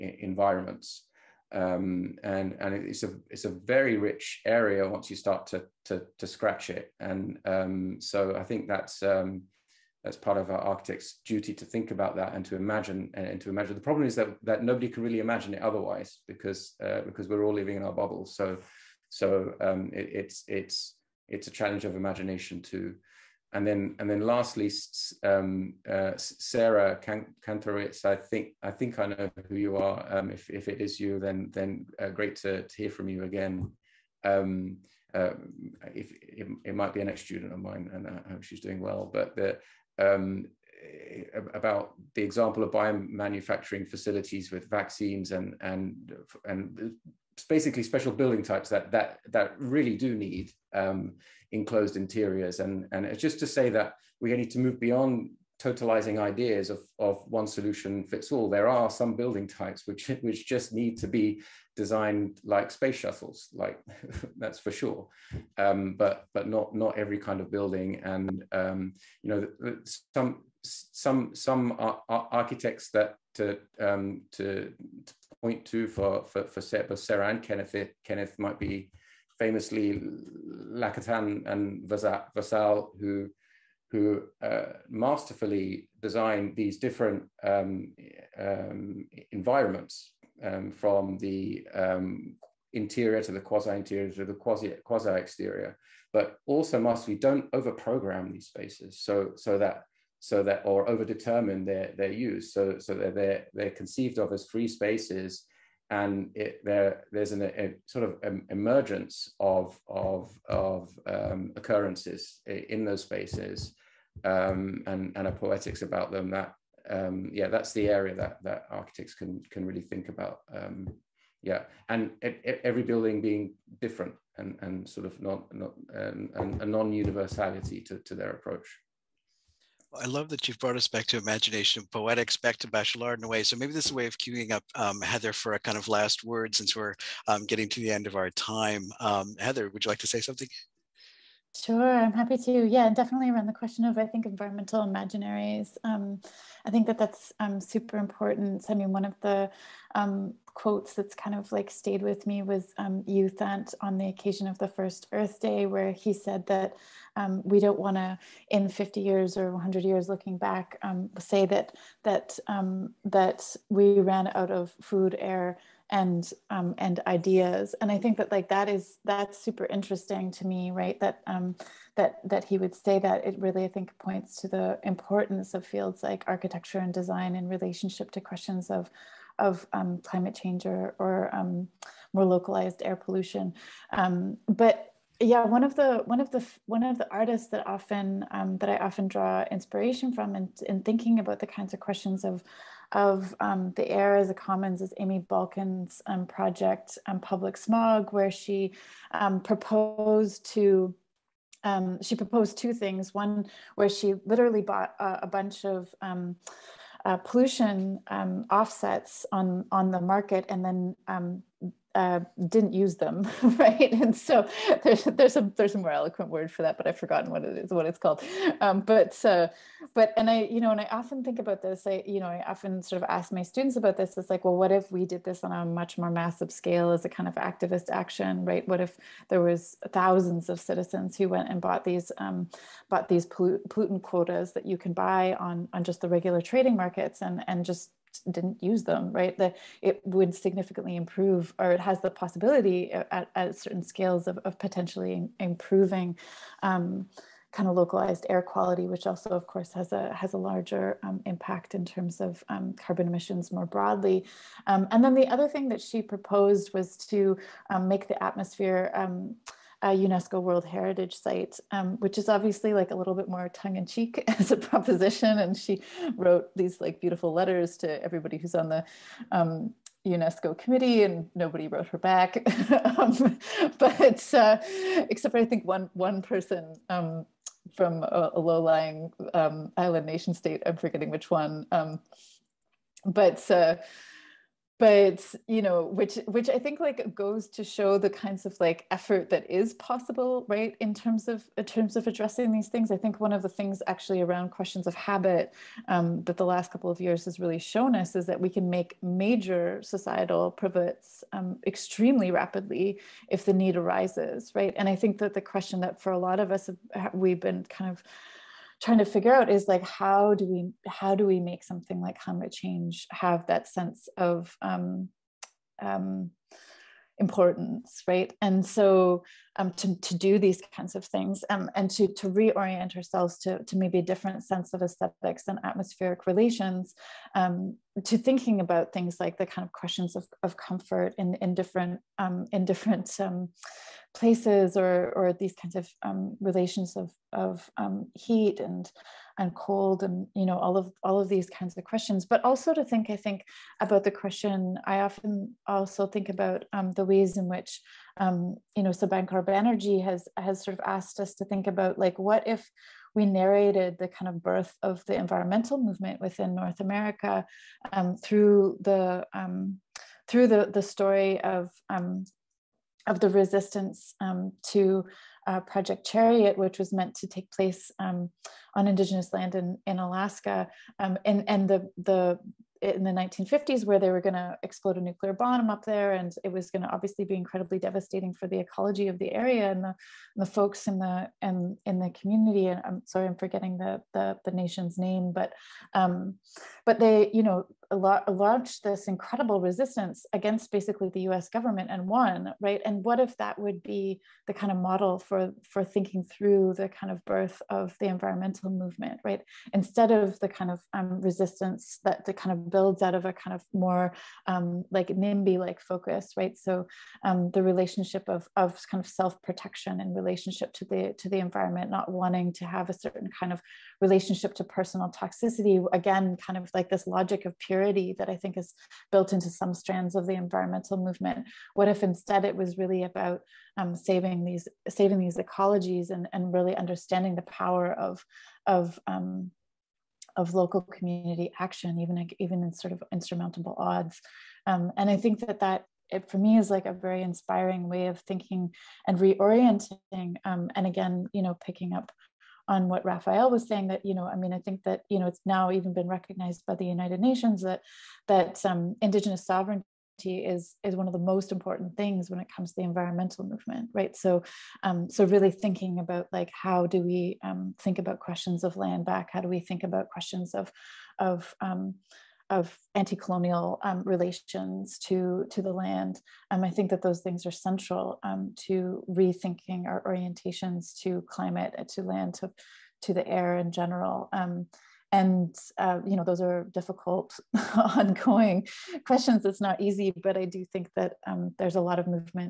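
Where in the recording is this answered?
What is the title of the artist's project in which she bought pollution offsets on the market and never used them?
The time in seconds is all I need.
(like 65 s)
197 s.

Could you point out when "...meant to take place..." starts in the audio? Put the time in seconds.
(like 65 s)
366 s.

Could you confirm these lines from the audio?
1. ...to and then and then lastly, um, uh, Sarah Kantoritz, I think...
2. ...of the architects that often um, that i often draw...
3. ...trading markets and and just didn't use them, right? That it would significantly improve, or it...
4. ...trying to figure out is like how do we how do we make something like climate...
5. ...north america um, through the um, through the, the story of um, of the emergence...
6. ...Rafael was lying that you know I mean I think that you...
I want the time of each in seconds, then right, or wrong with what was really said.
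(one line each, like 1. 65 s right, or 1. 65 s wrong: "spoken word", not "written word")
1. 22 s right
2. 186 s wrong: "artists", not "architects"
3. 236 s right
4. 308 s right
5. 356 s wrong: "resistance", not "emergence"
6. 443 s wrong: "saying", not "lying".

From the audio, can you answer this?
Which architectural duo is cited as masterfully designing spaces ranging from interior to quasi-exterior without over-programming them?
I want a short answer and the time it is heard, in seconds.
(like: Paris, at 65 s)
Lacaton and Vassal, at 80 s.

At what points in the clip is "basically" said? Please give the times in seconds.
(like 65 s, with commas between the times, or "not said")
47 s, 390 s.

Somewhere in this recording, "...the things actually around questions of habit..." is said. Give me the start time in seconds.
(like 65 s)
293 s.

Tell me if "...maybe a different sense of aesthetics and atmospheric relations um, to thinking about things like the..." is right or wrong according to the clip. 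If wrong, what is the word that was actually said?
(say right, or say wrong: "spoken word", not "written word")
right.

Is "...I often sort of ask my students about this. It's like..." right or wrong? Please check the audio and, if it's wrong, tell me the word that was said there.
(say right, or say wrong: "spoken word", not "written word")
right.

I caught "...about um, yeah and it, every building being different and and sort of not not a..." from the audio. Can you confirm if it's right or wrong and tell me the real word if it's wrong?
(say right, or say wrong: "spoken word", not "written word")
right.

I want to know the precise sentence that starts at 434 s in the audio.
Um, and I think that that it for me is like a very inspiring way of thinking and reorienting.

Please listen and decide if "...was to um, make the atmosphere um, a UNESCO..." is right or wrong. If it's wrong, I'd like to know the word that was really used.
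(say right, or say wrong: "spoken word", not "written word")
right.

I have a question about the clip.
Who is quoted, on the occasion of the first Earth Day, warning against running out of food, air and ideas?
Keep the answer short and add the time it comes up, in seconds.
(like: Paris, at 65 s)
U Thant, at 153 s.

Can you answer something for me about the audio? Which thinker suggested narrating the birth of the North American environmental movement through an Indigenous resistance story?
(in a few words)
Subhankar Banerjee.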